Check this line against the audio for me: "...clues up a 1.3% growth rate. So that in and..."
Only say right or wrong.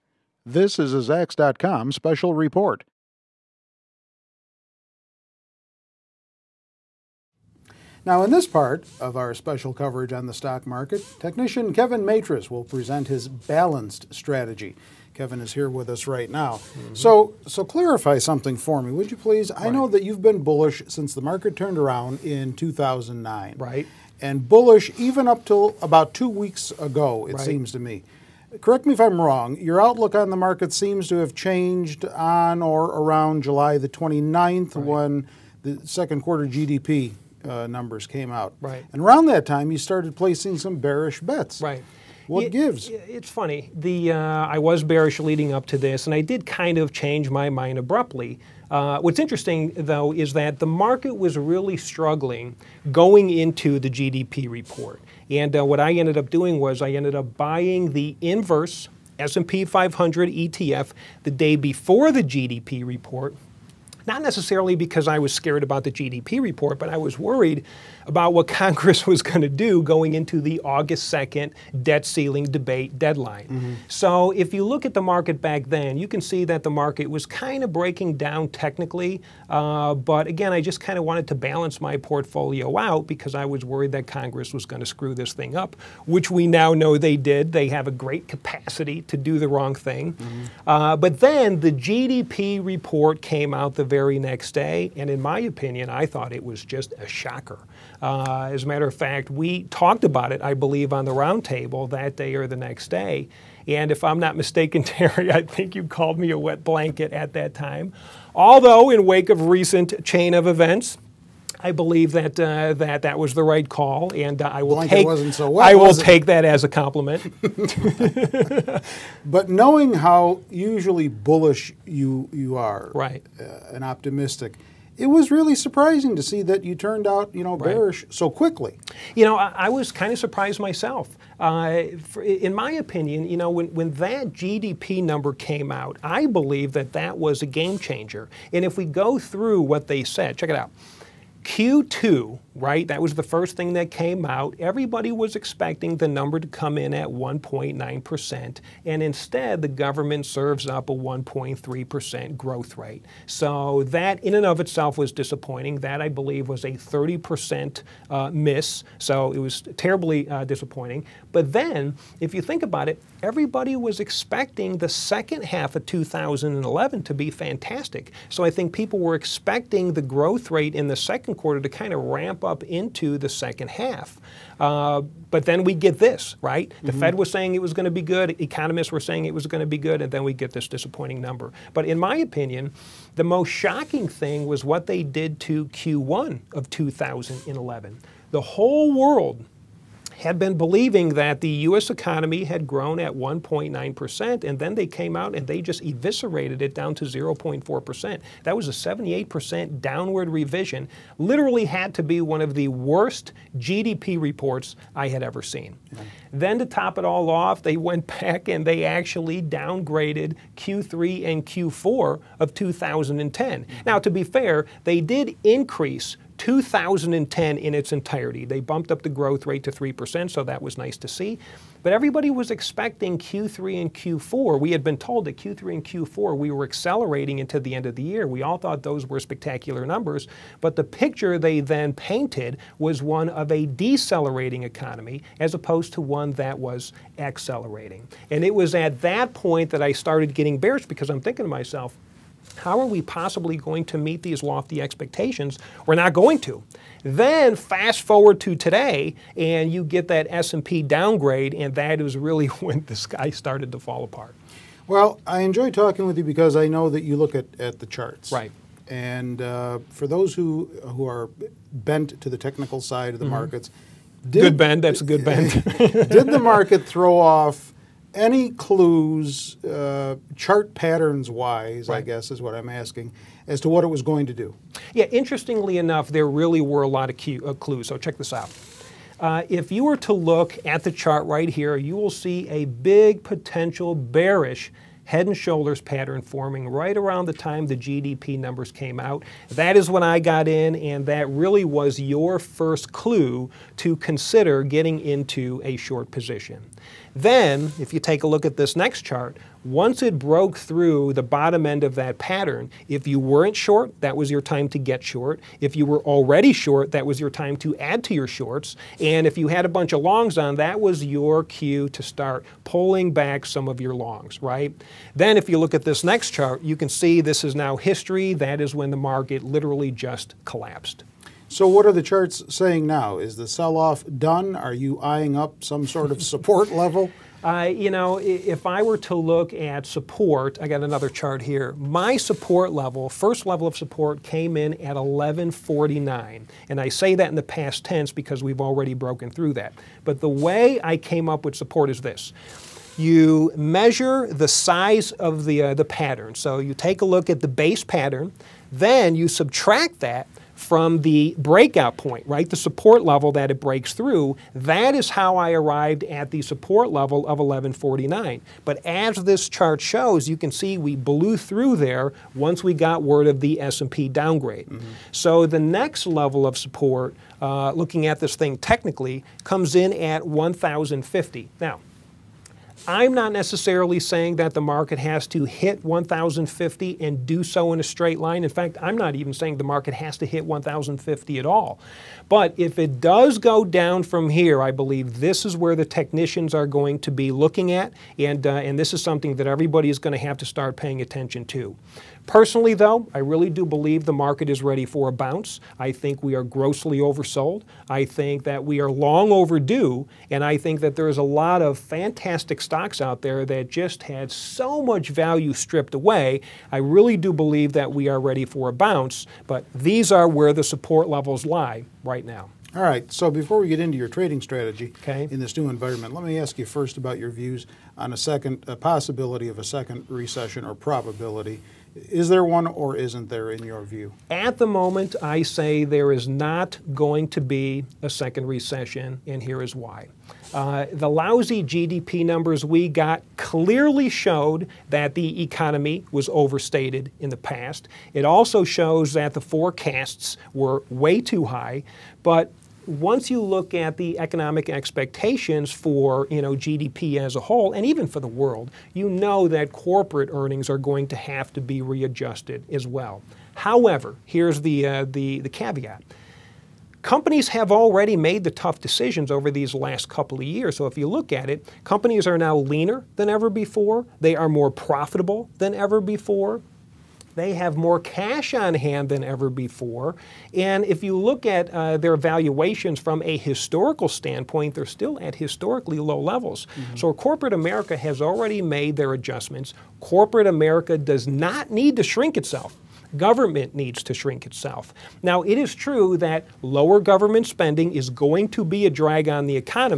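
wrong.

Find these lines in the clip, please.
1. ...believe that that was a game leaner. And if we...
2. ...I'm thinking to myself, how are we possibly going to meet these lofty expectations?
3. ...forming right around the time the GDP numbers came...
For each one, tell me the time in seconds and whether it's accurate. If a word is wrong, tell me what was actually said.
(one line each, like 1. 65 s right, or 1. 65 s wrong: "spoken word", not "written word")
1. 136 s wrong: "changer", not "leaner"
2. 241 s right
3. 286 s right.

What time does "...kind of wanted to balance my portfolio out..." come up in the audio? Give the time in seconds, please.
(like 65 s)
80 s.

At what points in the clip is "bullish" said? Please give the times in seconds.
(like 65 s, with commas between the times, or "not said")
20 s, 24 s, 121 s.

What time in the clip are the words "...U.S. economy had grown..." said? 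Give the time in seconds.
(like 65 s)
191 s.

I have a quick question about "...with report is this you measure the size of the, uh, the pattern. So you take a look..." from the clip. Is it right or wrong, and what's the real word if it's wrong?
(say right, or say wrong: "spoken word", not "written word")
wrong: "support", not "report".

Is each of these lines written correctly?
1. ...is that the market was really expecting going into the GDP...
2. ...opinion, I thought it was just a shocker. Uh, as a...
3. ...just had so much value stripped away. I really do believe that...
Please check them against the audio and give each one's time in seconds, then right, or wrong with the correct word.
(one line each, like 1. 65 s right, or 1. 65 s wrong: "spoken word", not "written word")
1. 50 s wrong: "struggling", not "expecting"
2. 95 s right
3. 403 s right.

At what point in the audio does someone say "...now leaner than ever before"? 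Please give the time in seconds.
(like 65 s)
462 s.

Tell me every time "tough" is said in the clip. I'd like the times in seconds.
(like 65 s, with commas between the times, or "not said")
458 s.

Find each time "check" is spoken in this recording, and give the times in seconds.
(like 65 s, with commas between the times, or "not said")
140 s, 277 s.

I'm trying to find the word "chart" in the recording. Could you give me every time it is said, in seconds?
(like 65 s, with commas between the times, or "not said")
257 s, 270 s, 280 s, 299 s, 316 s, 322 s, 331 s, 359 s.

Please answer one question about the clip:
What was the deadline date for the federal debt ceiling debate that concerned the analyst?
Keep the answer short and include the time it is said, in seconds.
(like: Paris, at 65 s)
August 2nd, at 70 s.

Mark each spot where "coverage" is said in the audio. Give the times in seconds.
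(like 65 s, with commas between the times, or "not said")
9 s.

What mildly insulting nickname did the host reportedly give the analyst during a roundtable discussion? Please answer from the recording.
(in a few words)
wet blanket.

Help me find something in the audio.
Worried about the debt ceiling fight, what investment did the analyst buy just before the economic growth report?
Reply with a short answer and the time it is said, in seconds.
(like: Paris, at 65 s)
inverse S&P 500 ETF, at 58 s.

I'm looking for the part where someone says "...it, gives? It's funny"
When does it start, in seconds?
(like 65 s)
42 s.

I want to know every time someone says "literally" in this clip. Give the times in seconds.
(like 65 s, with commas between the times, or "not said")
201 s, 319 s.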